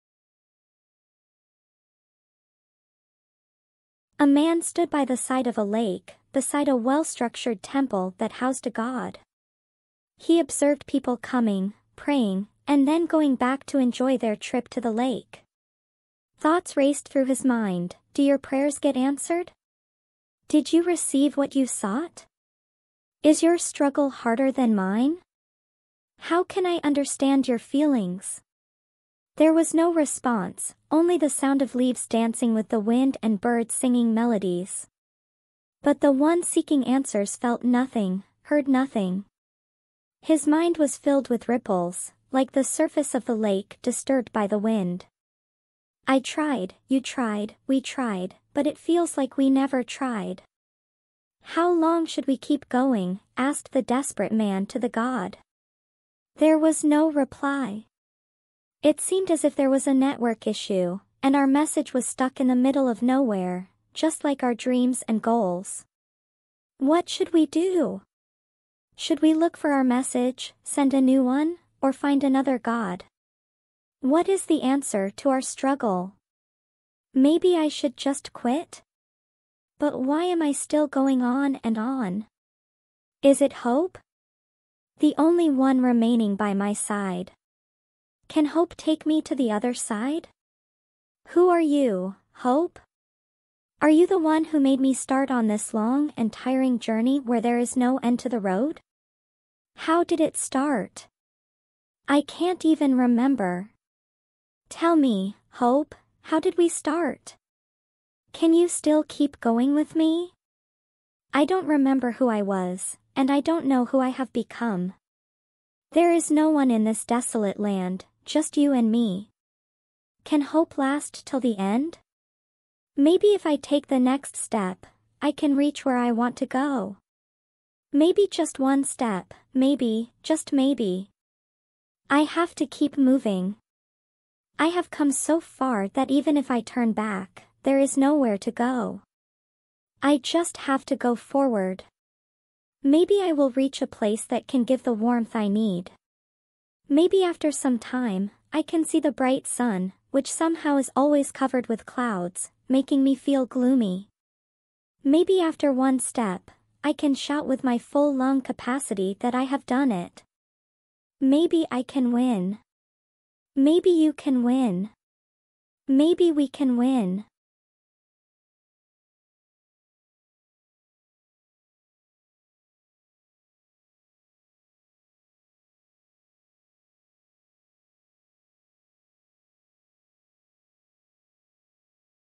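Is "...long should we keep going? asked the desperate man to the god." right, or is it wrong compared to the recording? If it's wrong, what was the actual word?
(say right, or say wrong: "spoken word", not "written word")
right.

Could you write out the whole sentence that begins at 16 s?
Thoughts raced through his mind, do your prayers get answered?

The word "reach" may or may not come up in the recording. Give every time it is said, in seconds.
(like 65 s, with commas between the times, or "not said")
125 s, 143 s.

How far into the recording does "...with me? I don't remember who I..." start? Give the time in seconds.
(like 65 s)
109 s.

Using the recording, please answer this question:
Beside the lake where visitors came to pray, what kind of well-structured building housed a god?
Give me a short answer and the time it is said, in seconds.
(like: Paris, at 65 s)
temple, at 7 s.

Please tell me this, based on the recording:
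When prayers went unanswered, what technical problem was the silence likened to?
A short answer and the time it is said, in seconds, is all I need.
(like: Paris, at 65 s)
network issue, at 59 s.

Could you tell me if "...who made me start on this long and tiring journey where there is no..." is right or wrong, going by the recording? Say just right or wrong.
right.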